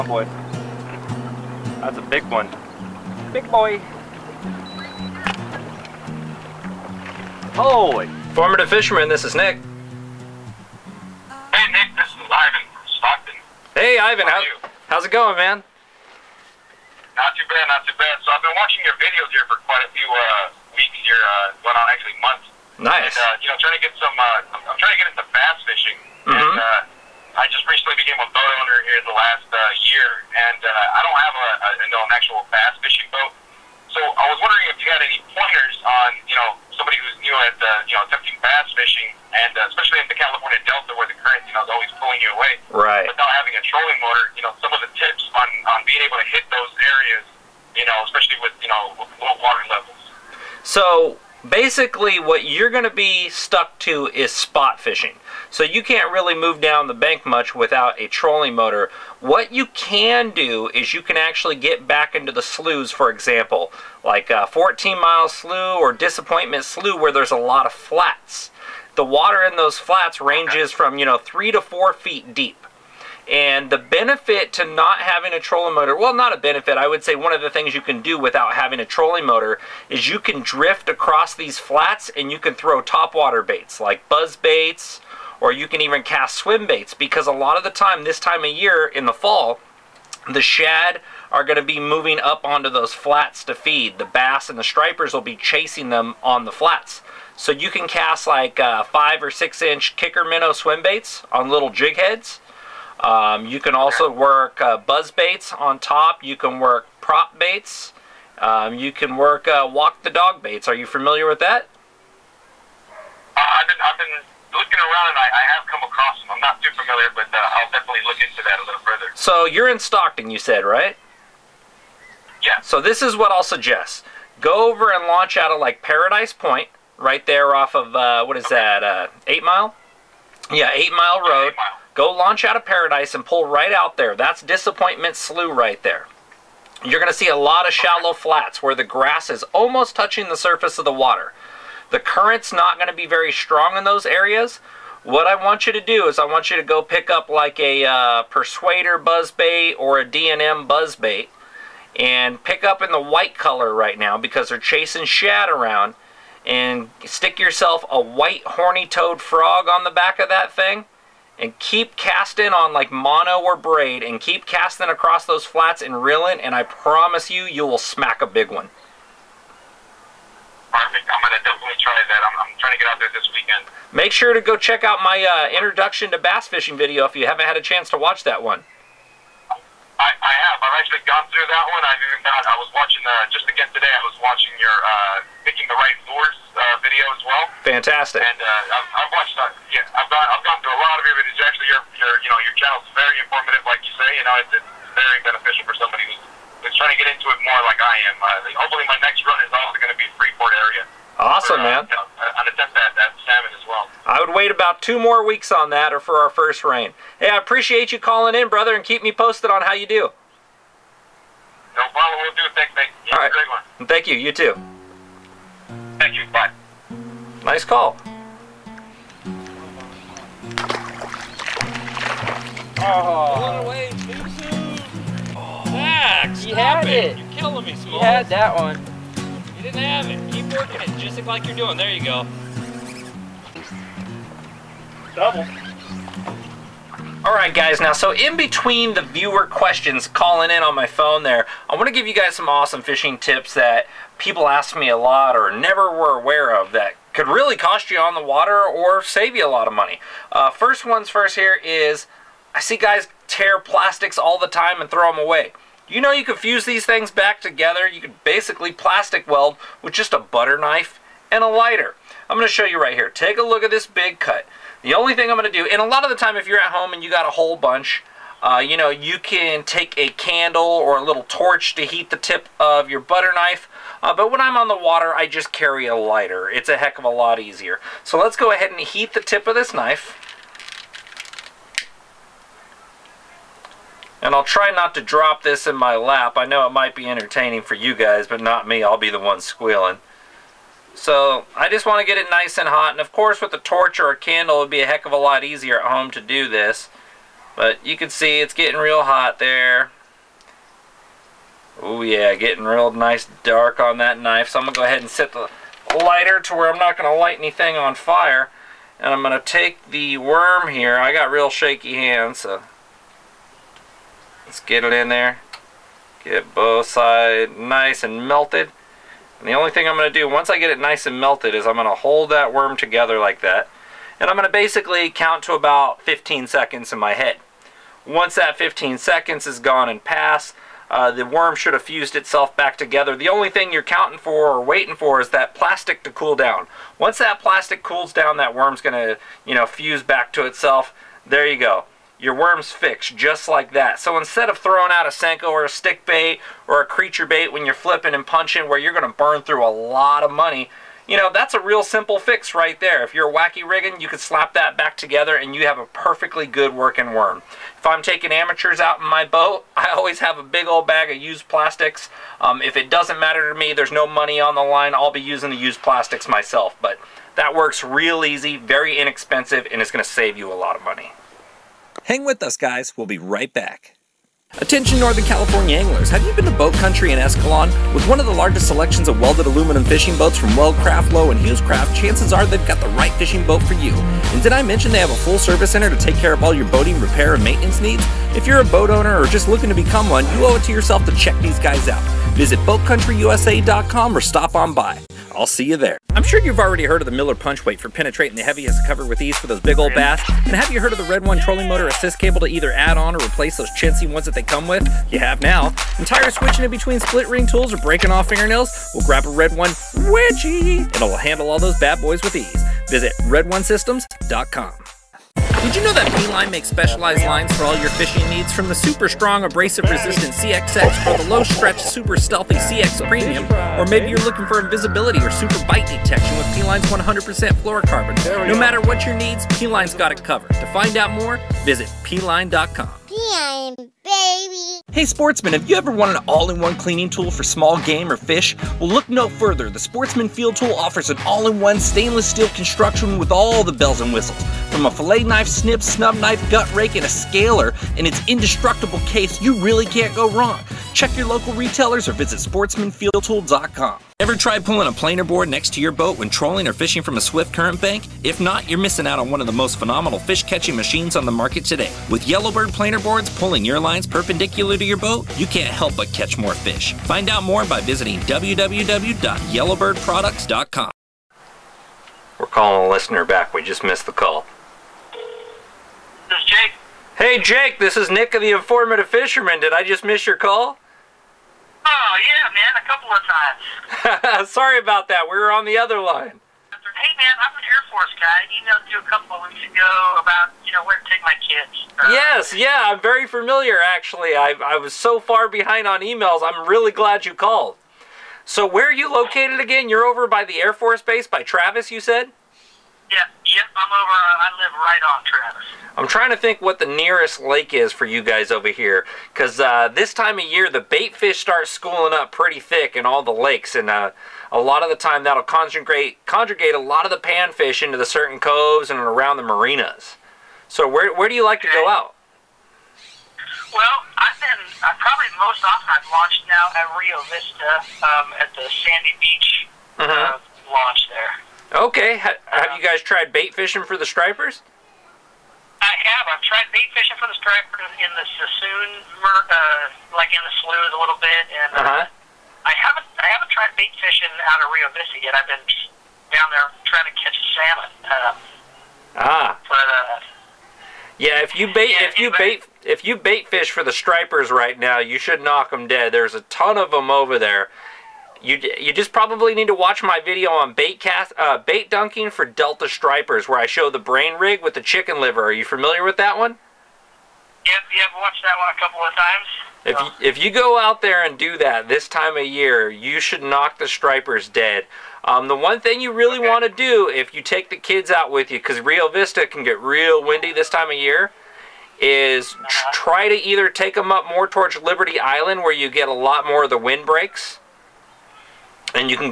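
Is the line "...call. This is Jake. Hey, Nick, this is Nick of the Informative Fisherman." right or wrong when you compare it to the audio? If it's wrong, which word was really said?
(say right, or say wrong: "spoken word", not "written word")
wrong: "Jake", not "Nick".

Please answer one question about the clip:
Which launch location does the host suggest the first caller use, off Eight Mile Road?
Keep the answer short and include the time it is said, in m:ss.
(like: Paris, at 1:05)
Paradise Point, at 2:05.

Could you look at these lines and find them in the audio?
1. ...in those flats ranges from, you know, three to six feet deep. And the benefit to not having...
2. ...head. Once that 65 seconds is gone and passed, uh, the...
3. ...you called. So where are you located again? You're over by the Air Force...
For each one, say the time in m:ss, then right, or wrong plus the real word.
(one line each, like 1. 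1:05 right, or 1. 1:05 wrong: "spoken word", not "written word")
1. 1:09 wrong: "four", not "six"
2. 5:27 wrong: "15", not "65"
3. 8:17 right.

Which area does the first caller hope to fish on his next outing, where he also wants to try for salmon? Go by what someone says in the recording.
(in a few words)
Freeport.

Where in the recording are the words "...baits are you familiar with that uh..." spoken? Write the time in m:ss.
1:50.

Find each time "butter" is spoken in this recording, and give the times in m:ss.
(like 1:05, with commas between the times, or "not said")
4:20, 4:33.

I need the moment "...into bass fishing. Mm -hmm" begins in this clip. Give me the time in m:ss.
0:25.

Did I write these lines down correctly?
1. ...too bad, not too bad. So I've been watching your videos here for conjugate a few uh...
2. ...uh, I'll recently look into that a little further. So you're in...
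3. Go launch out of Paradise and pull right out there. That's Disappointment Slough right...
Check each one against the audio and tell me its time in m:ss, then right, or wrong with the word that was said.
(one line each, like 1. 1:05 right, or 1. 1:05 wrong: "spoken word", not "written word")
1. 0:17 wrong: "quite", not "conjugate"
2. 1:57 wrong: "definitely", not "recently"
3. 2:11 right.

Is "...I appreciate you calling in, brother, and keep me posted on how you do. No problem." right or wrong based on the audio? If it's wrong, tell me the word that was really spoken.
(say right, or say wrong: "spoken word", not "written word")
right.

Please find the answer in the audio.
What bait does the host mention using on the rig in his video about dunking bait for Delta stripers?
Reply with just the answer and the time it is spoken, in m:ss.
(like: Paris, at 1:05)
chicken liver, at 9:24.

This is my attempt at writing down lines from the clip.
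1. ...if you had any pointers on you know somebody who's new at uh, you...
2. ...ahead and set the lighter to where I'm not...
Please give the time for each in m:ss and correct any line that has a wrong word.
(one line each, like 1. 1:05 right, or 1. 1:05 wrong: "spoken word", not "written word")
1. 0:34 right
2. 5:04 right.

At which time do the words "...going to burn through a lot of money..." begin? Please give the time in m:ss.
5:48.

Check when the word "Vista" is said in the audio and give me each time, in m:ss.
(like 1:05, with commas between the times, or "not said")
8:47, 9:04, 9:39.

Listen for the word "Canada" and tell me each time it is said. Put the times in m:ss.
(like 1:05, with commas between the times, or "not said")
not said.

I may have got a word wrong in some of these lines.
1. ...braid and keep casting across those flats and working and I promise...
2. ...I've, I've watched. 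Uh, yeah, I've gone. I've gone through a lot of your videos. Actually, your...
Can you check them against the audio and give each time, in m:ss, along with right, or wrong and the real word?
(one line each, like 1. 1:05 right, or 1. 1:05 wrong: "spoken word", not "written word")
1. 2:43 wrong: "reeling", not "working"
2. 3:08 right.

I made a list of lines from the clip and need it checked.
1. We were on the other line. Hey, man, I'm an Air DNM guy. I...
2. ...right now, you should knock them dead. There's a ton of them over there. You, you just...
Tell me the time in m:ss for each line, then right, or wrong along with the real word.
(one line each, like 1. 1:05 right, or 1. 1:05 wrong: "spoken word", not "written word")
1. 8:05 wrong: "Force", not "DNM"
2. 9:14 right.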